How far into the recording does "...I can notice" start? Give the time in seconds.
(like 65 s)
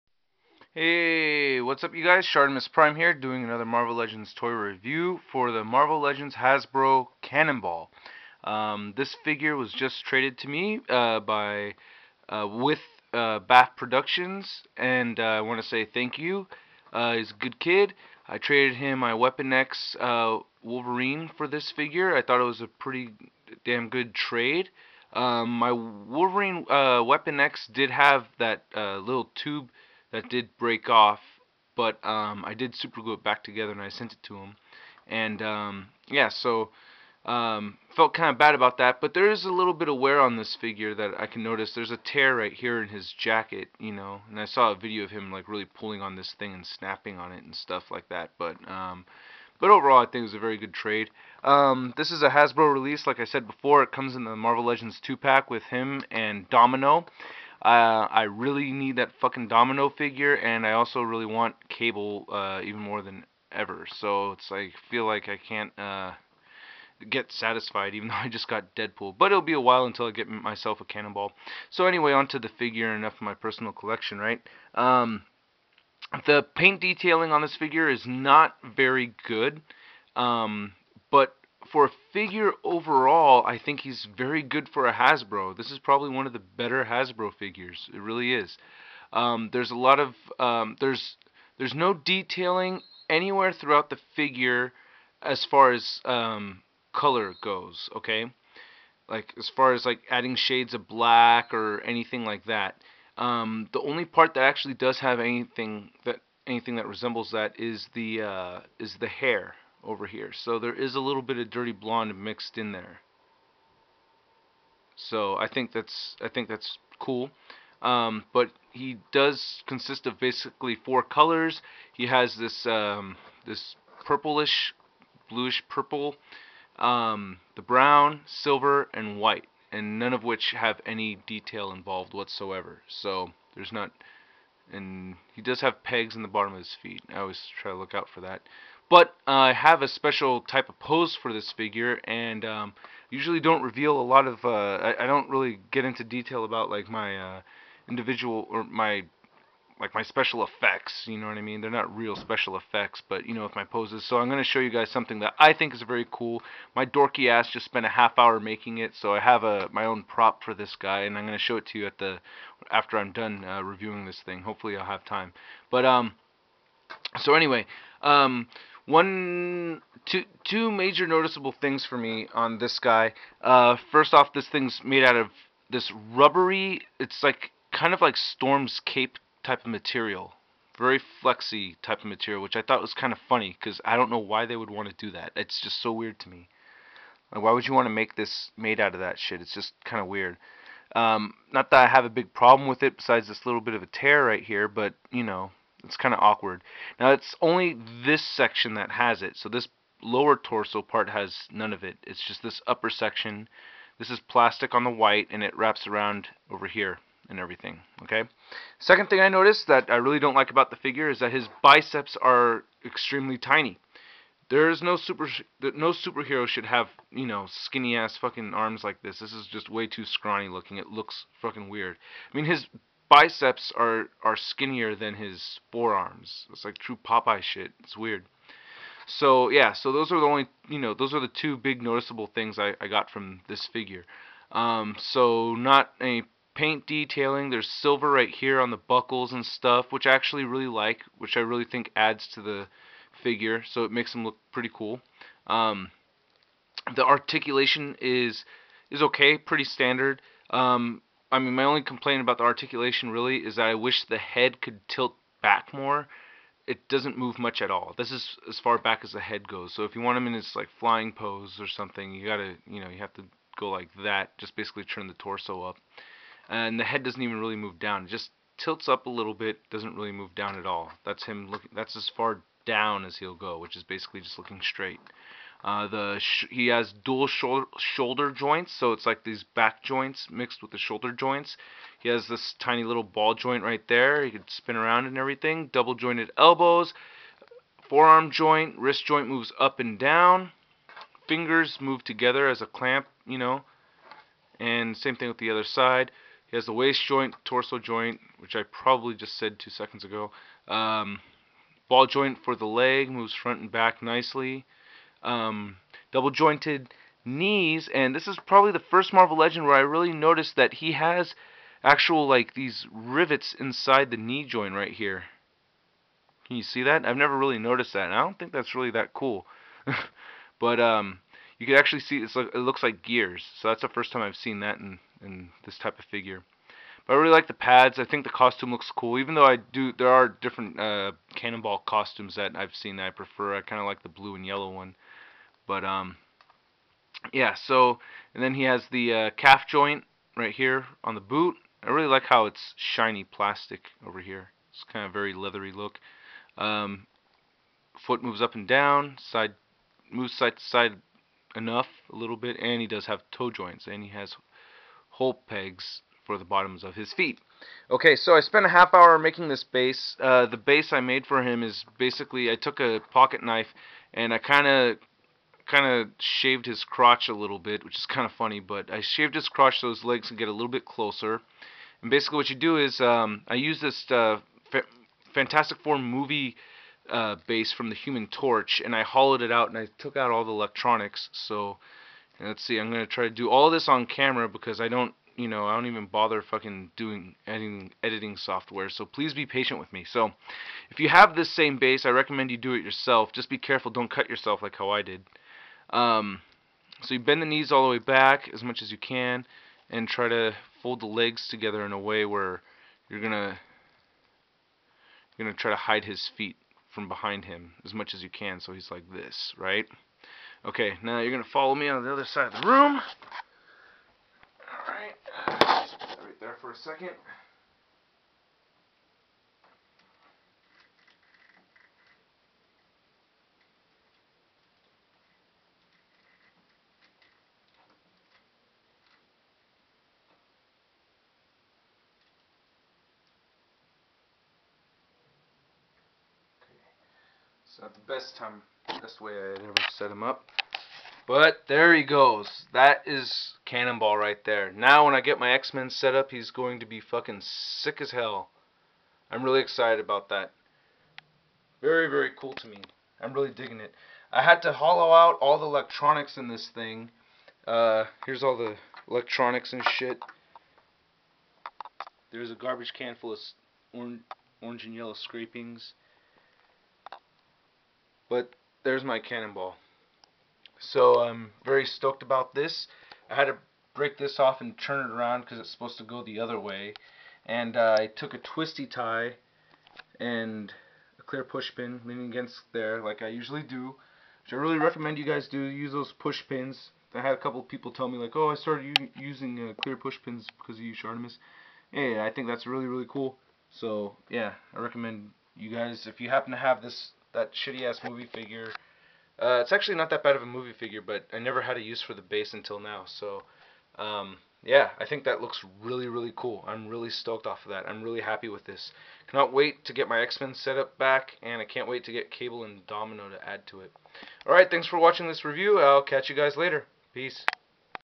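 41 s.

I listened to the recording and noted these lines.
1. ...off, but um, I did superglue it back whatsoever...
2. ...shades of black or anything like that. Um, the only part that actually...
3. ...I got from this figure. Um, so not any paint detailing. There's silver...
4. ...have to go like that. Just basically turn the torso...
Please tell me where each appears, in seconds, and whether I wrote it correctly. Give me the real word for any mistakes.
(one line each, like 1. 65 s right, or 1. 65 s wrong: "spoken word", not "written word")
1. 30 s wrong: "together", not "whatsoever"
2. 100 s right
3. 232 s right
4. 262 s right.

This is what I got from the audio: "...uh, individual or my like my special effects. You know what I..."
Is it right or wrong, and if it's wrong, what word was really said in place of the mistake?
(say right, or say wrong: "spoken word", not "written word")
right.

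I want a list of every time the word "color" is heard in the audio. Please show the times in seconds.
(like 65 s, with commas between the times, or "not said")
96 s, 121 s.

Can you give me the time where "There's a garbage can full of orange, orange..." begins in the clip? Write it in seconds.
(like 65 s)
462 s.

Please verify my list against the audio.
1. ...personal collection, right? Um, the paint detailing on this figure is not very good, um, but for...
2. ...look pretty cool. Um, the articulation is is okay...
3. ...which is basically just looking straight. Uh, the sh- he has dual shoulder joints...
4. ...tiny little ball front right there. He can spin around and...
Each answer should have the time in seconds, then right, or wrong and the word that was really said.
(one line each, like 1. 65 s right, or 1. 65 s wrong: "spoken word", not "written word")
1. 73 s right
2. 244 s right
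3. 273 s right
4. 282 s wrong: "joint", not "front".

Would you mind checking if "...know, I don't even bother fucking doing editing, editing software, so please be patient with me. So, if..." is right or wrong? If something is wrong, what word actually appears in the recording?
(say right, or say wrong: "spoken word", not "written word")
right.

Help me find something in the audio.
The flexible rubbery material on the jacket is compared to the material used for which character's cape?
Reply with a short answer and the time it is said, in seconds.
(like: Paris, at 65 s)
Storm, at 178 s.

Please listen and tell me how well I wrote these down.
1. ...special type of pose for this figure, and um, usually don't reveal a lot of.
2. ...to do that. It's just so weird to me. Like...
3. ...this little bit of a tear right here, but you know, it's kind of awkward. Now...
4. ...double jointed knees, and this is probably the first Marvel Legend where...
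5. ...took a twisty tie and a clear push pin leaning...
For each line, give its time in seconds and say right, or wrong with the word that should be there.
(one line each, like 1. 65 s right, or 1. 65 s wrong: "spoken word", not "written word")
1. 139 s right
2. 184 s right
3. 193 s right
4. 306 s right
5. 478 s right.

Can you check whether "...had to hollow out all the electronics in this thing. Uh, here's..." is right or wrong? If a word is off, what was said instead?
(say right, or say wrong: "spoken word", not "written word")
right.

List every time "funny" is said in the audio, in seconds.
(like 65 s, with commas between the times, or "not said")
183 s, 368 s.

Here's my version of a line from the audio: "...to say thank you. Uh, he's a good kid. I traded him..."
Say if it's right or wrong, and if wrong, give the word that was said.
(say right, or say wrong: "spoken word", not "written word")
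right.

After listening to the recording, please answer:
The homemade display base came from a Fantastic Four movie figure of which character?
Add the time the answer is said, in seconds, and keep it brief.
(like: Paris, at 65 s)
Human Torch, at 377 s.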